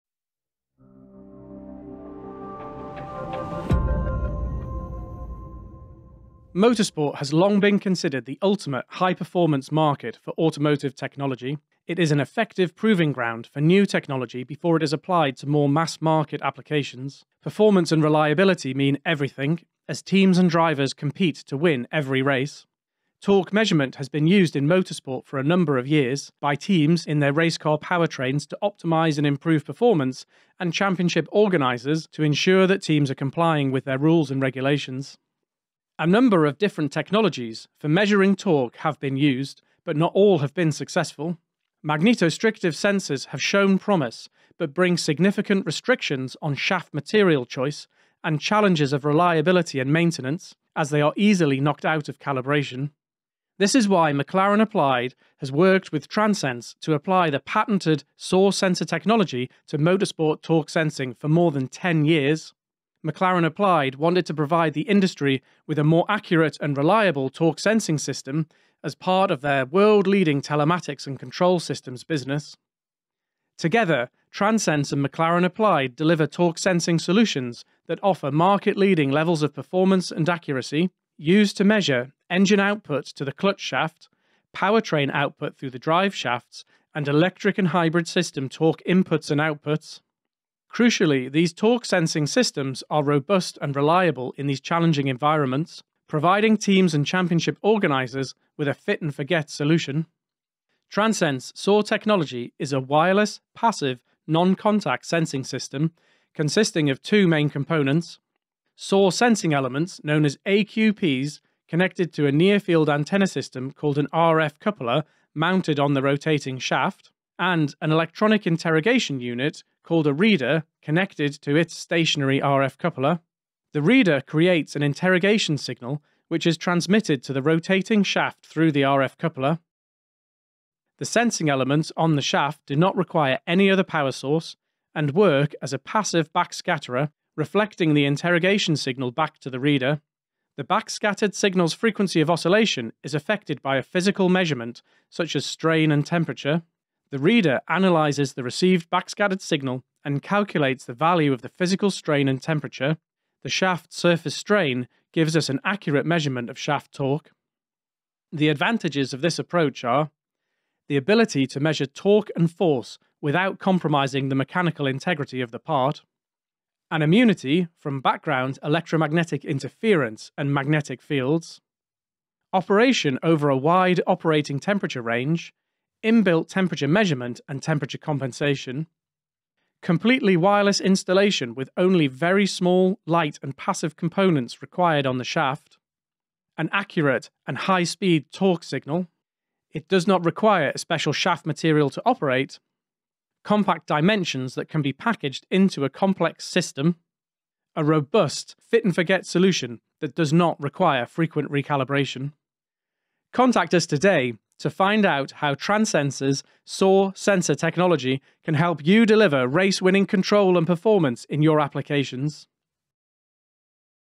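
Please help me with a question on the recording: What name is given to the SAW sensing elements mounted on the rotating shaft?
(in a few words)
AQPs.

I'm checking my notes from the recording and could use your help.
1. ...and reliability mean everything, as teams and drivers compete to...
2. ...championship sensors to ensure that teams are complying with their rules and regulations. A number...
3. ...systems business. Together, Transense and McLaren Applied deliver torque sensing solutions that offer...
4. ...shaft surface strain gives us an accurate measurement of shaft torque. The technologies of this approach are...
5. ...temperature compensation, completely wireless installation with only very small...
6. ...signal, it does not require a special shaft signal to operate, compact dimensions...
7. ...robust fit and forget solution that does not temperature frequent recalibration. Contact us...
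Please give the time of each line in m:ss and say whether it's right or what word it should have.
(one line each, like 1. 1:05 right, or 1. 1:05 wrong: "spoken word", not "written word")
1. 0:17 right
2. 0:30 wrong: "organizers", not "sensors"
3. 1:11 right
4. 2:33 wrong: "advantages", not "technologies"
5. 2:57 right
6. 3:08 wrong: "material", not "signal"
7. 3:17 wrong: "require", not "temperature".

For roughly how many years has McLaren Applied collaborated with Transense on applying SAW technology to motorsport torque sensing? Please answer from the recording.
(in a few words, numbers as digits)
more than 10 years.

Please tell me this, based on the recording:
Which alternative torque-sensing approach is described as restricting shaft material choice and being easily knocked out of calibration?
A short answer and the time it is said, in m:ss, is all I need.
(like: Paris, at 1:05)
Magnetostrictive sensors, at 0:41.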